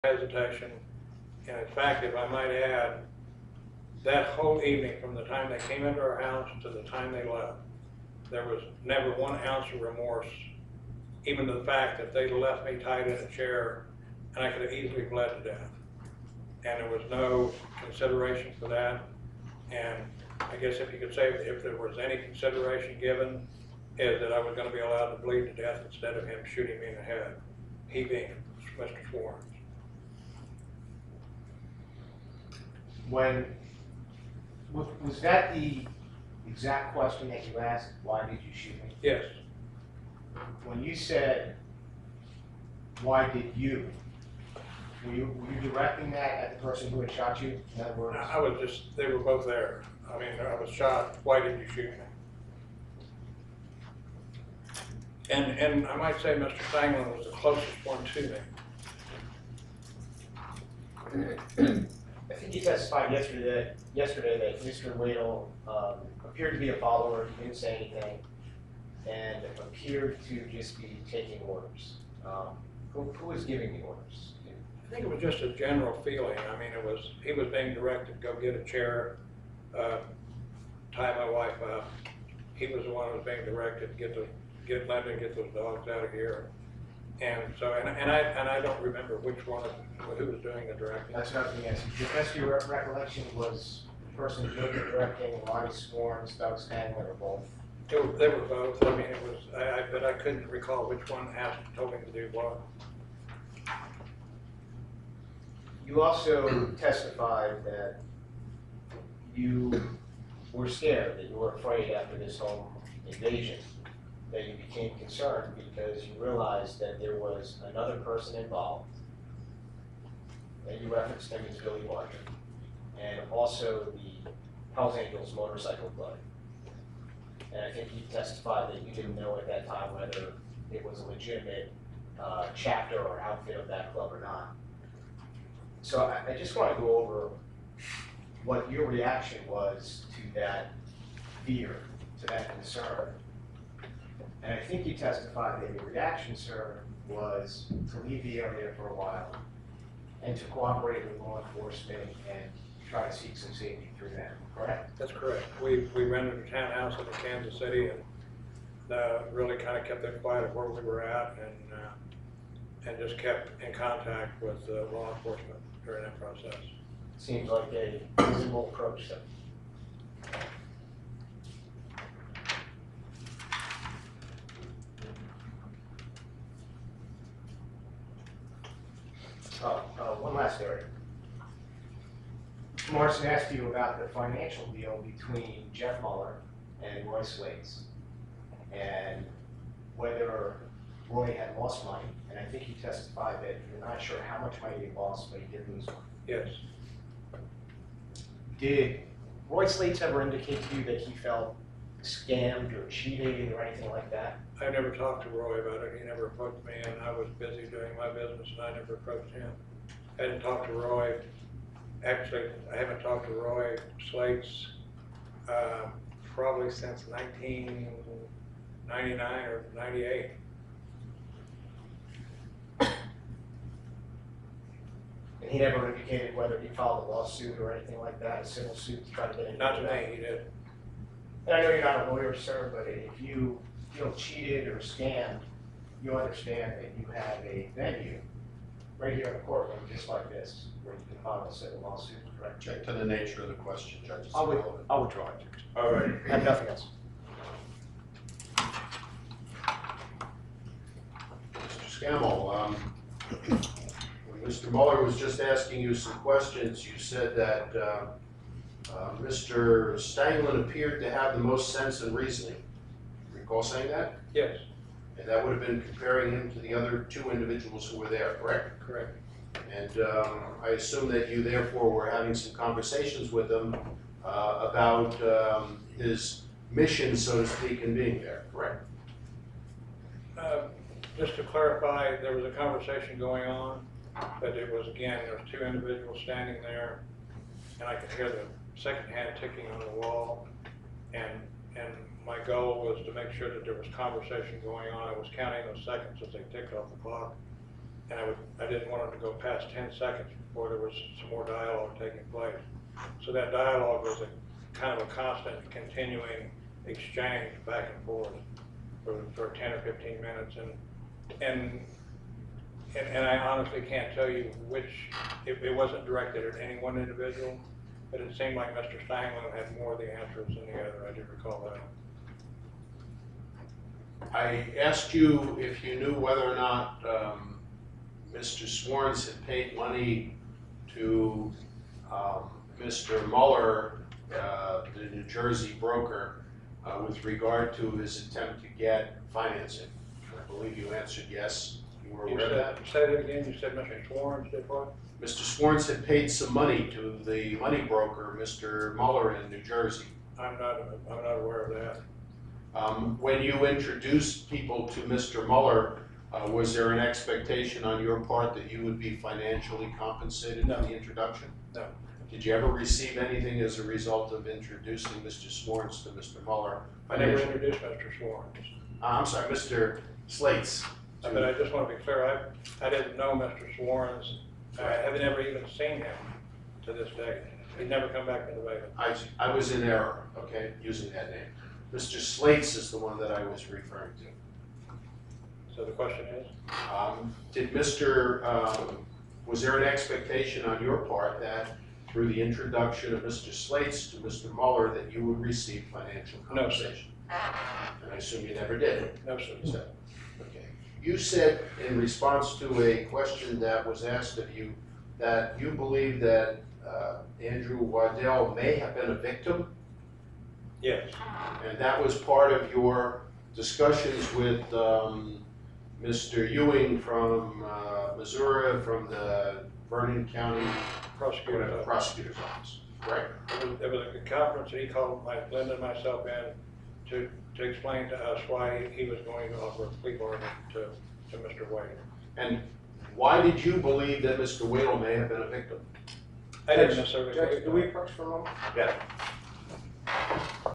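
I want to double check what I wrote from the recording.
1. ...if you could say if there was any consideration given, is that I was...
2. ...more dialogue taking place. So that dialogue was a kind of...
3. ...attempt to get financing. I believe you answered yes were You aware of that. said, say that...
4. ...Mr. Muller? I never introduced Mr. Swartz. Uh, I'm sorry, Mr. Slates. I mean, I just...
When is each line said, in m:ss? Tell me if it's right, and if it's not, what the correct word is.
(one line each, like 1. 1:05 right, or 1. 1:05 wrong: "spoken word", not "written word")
1. 0:20 right
2. 5:01 right
3. 5:38 right
4. 6:06 right.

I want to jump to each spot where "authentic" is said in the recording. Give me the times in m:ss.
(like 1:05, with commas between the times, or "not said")
not said.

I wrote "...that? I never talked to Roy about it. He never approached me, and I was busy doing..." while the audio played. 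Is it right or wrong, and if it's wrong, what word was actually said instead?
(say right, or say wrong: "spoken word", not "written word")
right.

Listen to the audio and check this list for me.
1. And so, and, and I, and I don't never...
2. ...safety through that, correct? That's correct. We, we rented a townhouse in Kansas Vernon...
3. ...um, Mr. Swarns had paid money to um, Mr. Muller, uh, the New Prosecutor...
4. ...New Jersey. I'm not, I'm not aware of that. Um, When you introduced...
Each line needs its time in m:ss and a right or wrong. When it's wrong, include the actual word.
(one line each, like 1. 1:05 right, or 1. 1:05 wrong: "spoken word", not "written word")
1. 1:27 wrong: "remember", not "never"
2. 2:33 wrong: "City", not "Vernon"
3. 5:27 wrong: "Jersey", not "Prosecutor"
4. 5:49 right.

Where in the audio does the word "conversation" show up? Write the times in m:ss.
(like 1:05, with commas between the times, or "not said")
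4:32, 4:42, 4:53.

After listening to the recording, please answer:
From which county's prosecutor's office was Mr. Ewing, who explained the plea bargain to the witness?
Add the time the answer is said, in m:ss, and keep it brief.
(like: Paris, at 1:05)
Vernon County, at 6:59.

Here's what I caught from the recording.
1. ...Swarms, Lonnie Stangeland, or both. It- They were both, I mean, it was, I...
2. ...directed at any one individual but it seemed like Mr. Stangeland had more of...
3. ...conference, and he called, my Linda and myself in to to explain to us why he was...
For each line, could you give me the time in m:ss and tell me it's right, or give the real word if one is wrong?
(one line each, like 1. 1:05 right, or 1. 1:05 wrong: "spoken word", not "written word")
1. 1:35 wrong: "Doug", not "Lonnie"
2. 5:16 right
3. 7:04 right.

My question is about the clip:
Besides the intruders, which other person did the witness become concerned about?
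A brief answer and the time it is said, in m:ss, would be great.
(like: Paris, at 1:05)
Billy Barker, at 2:01.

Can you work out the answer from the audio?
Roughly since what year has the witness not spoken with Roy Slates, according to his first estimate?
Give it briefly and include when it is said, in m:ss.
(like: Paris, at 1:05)
1999, at 3:37.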